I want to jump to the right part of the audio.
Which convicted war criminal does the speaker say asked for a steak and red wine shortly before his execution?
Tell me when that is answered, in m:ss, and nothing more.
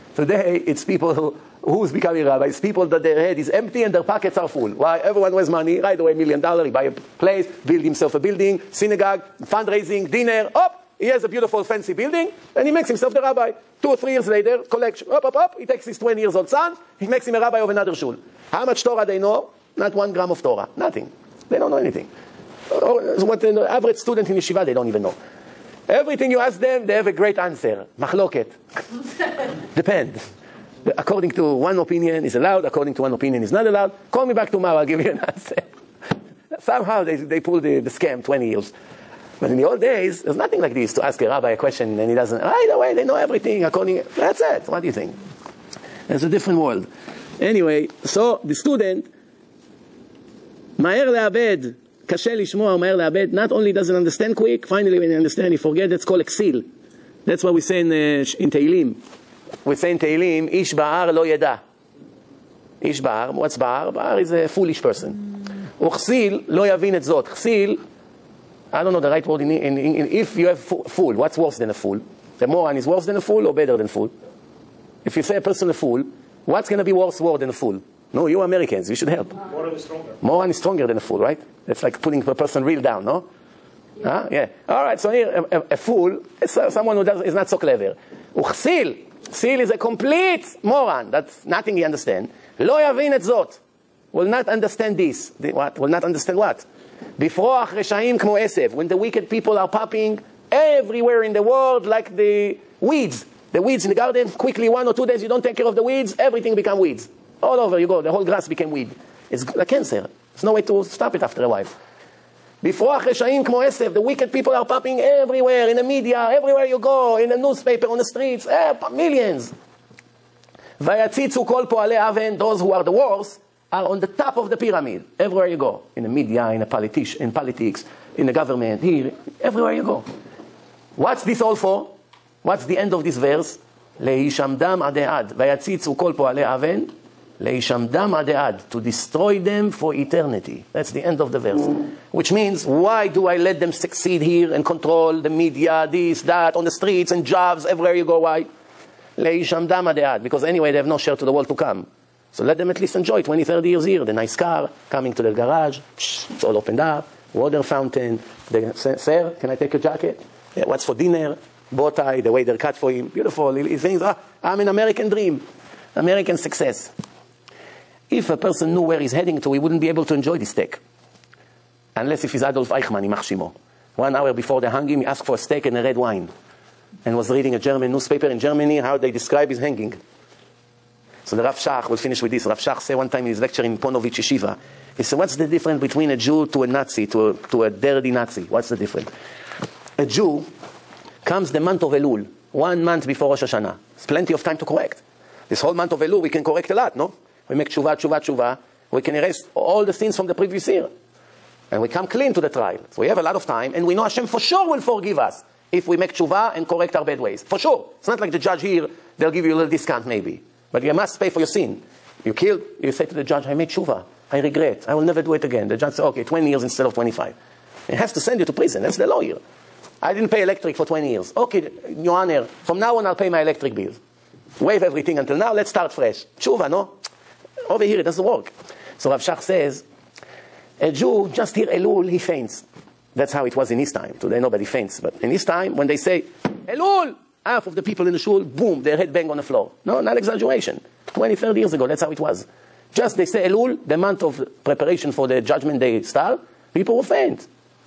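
2:52.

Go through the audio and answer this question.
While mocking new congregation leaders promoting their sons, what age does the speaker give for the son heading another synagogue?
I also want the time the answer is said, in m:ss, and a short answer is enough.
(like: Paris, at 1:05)
20, at 0:15.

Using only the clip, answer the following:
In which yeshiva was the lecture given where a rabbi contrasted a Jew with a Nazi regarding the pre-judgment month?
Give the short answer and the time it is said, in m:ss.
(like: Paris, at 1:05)
Ponevezh, at 3:03.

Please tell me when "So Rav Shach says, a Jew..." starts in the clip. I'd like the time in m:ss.
3:48.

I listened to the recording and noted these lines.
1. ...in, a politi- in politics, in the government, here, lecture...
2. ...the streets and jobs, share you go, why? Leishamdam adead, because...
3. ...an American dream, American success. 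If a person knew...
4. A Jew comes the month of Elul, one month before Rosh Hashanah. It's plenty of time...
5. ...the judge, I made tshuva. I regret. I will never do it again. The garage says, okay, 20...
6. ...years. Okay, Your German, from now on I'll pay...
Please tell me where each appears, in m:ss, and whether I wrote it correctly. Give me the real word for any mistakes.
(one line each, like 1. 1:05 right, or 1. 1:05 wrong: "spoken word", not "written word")
1. 2:06 wrong: "everywhere", not "lecture"
2. 2:26 wrong: "everywhere", not "share"
3. 2:44 right
4. 3:09 right
5. 3:33 wrong: "judge", not "garage"
6. 3:41 wrong: "Honor", not "German".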